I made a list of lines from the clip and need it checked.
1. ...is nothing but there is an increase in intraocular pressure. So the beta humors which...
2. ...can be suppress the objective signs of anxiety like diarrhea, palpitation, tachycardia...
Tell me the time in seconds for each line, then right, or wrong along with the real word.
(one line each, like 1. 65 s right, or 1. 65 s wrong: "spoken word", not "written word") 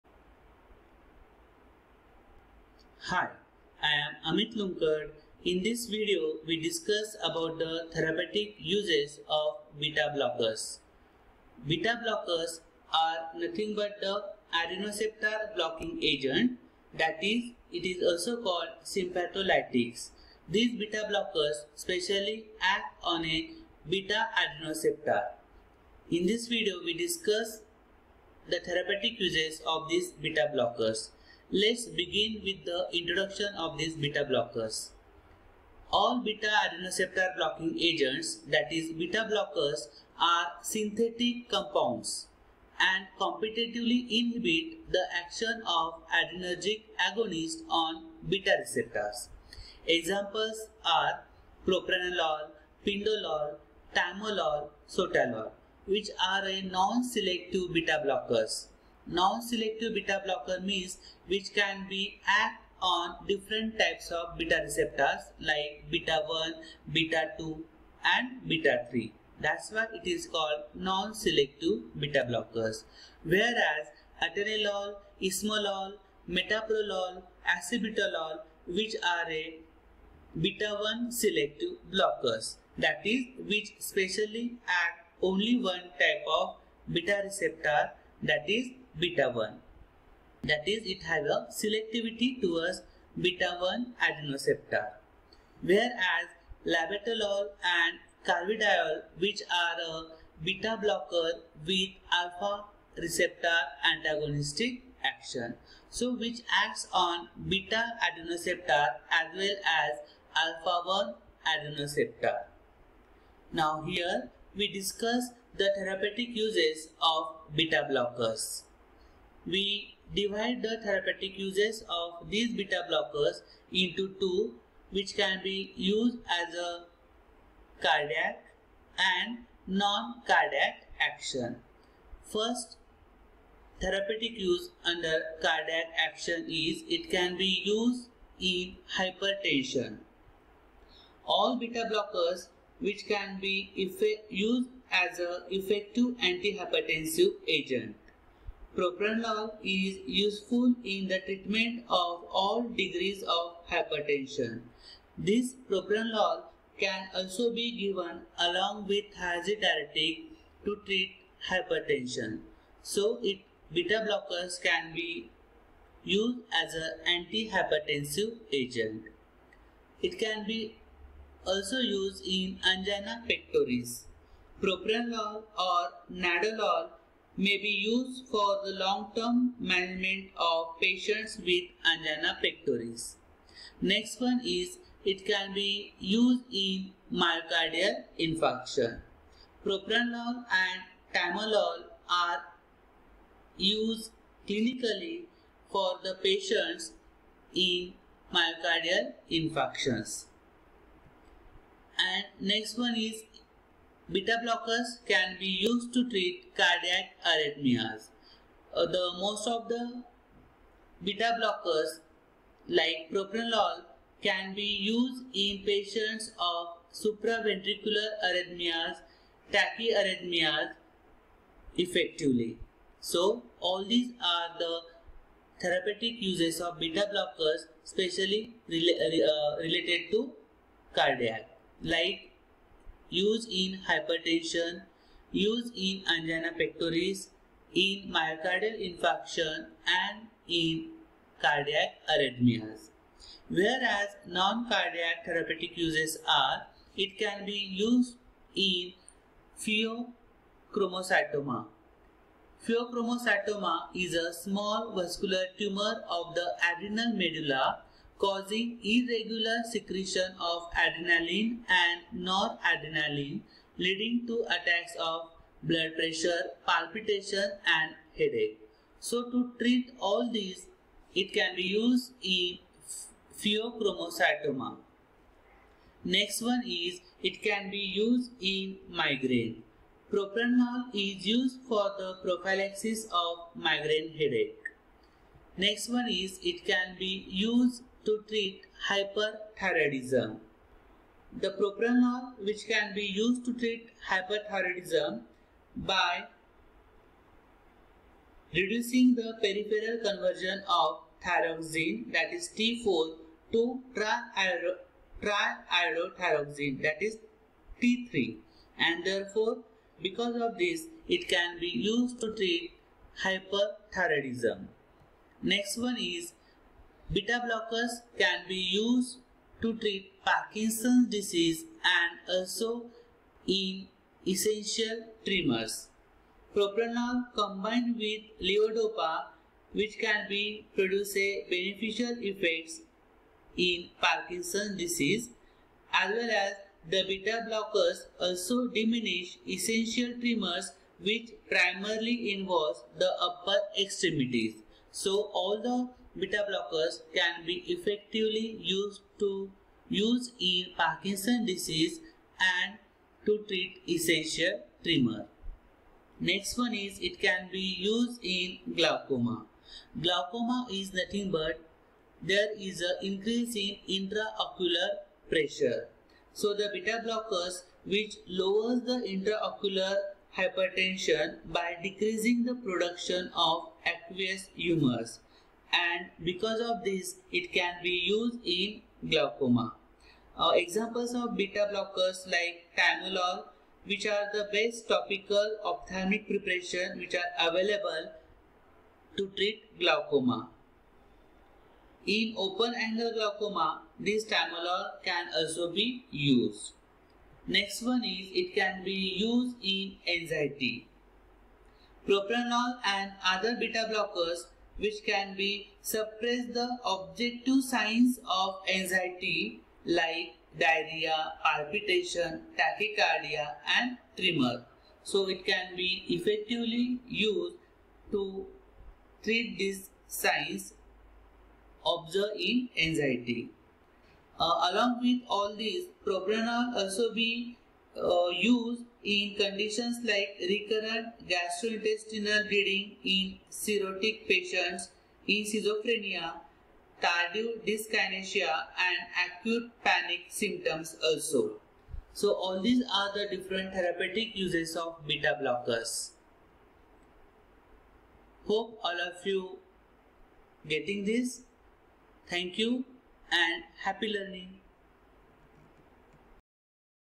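1. 360 s wrong: "blockers", not "humors"
2. 405 s right.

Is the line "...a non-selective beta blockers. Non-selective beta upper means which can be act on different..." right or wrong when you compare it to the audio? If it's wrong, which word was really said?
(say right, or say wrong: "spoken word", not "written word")
wrong: "blocker", not "upper".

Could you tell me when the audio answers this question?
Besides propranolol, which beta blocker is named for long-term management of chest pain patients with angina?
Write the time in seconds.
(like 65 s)
176 s.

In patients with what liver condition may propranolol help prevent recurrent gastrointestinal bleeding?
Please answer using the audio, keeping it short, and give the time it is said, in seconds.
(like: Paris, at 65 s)
Cirrhotic, at 433 s.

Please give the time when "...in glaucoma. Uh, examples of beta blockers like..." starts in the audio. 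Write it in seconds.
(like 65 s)
378 s.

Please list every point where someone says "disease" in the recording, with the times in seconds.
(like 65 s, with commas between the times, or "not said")
321 s, 334 s, 351 s.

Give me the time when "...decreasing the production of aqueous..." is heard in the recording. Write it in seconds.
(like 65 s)
371 s.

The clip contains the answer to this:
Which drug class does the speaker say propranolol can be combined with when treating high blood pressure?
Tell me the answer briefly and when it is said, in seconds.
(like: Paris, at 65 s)
Thiazide diuretic, at 159 s.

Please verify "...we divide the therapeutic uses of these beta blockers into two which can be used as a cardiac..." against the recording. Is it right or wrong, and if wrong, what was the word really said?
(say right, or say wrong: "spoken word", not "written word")
right.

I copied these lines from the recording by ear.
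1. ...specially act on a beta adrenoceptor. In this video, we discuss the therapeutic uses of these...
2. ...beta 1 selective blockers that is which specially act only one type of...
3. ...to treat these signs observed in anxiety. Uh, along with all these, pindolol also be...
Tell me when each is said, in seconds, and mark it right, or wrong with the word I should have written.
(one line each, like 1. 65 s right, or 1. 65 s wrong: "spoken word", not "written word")
1. 21 s right
2. 80 s right
3. 418 s wrong: "propranolol", not "pindolol".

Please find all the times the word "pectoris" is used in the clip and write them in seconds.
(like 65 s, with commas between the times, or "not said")
173 s, 182 s, 236 s.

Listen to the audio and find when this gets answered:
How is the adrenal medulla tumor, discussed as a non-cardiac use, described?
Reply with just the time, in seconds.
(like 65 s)
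254 s.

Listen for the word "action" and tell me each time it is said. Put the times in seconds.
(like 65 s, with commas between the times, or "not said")
45 s, 105 s, 130 s, 135 s.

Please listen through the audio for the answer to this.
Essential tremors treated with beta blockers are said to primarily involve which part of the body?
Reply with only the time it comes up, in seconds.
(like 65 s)
343 s.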